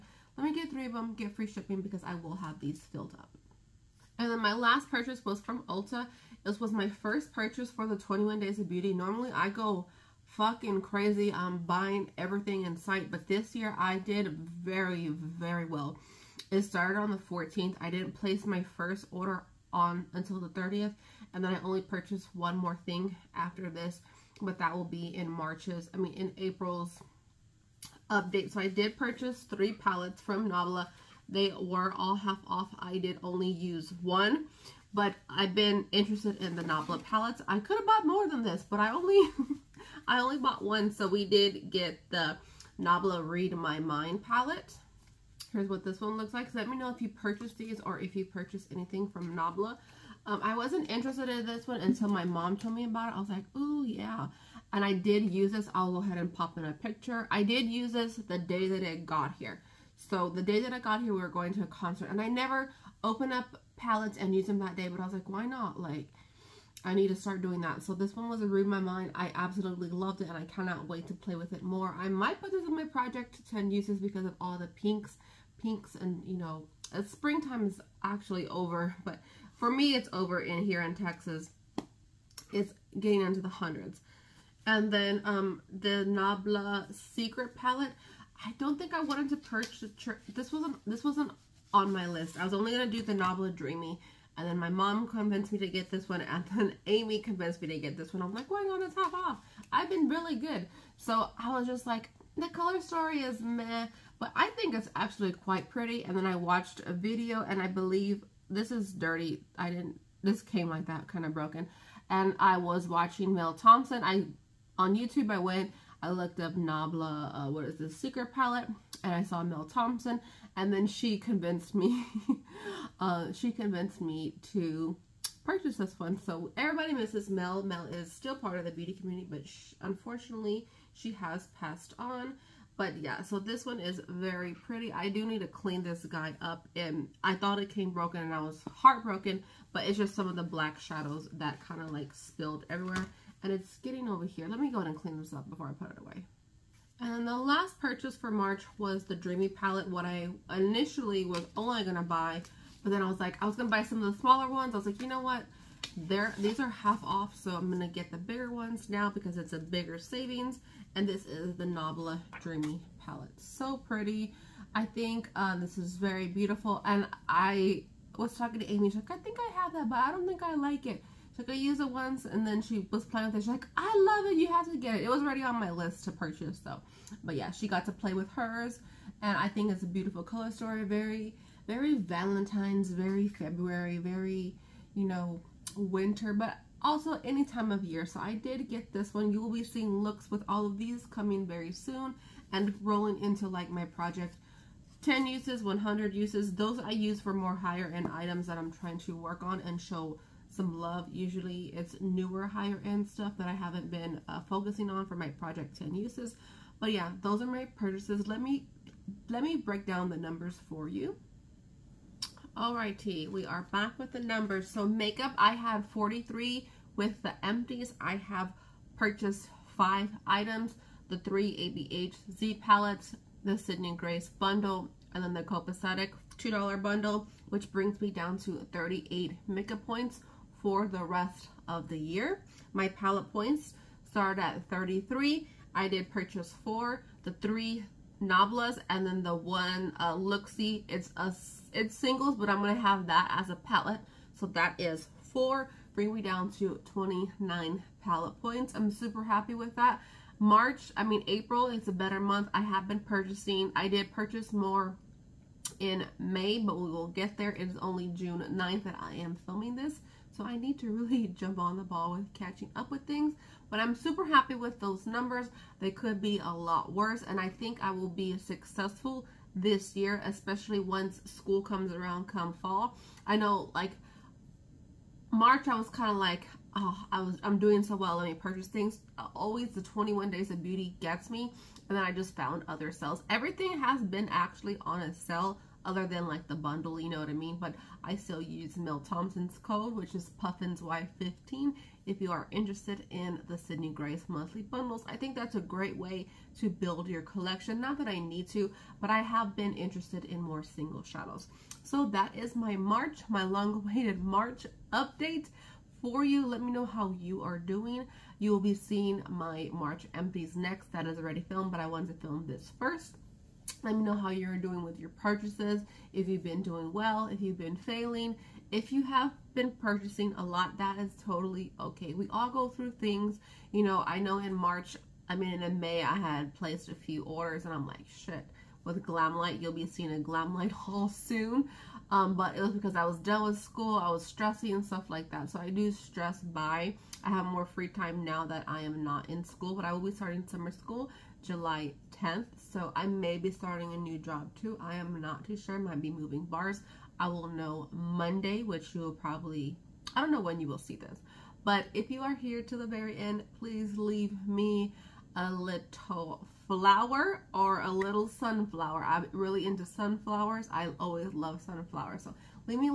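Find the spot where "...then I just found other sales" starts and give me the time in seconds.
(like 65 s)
281 s.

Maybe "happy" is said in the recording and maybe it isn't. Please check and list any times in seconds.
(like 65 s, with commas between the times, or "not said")
249 s, 264 s.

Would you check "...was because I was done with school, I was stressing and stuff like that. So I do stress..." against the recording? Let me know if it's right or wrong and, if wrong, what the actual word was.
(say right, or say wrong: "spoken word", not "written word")
right.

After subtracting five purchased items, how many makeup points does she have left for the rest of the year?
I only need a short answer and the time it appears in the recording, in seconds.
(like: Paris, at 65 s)
38, at 228 s.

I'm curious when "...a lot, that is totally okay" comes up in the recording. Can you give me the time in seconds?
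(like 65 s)
320 s.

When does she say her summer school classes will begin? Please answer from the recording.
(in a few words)
July 10th.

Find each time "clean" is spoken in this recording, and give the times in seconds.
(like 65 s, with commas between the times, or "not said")
135 s, 144 s.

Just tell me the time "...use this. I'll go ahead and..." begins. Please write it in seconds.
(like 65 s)
55 s.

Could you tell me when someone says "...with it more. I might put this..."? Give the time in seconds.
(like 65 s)
71 s.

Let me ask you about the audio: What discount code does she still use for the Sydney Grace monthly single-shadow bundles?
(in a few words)
Puffins Y15.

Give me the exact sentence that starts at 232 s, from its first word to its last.
My palette points start at 33.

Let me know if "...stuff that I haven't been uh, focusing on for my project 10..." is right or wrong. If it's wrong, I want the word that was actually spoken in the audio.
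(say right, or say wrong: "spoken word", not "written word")
right.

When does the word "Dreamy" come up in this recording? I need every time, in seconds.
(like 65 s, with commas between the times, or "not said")
93 s, 149 s, 162 s.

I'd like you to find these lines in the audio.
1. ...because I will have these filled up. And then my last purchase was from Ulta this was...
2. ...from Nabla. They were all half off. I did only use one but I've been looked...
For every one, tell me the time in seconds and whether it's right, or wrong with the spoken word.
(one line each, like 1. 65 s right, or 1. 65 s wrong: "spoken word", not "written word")
1. 1 s right
2. 30 s wrong: "interested", not "looked".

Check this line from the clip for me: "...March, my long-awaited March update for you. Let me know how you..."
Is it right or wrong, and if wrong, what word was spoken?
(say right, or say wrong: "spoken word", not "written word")
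right.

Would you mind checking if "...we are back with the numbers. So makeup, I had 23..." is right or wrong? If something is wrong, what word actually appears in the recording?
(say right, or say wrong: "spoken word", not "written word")
wrong: "43", not "23".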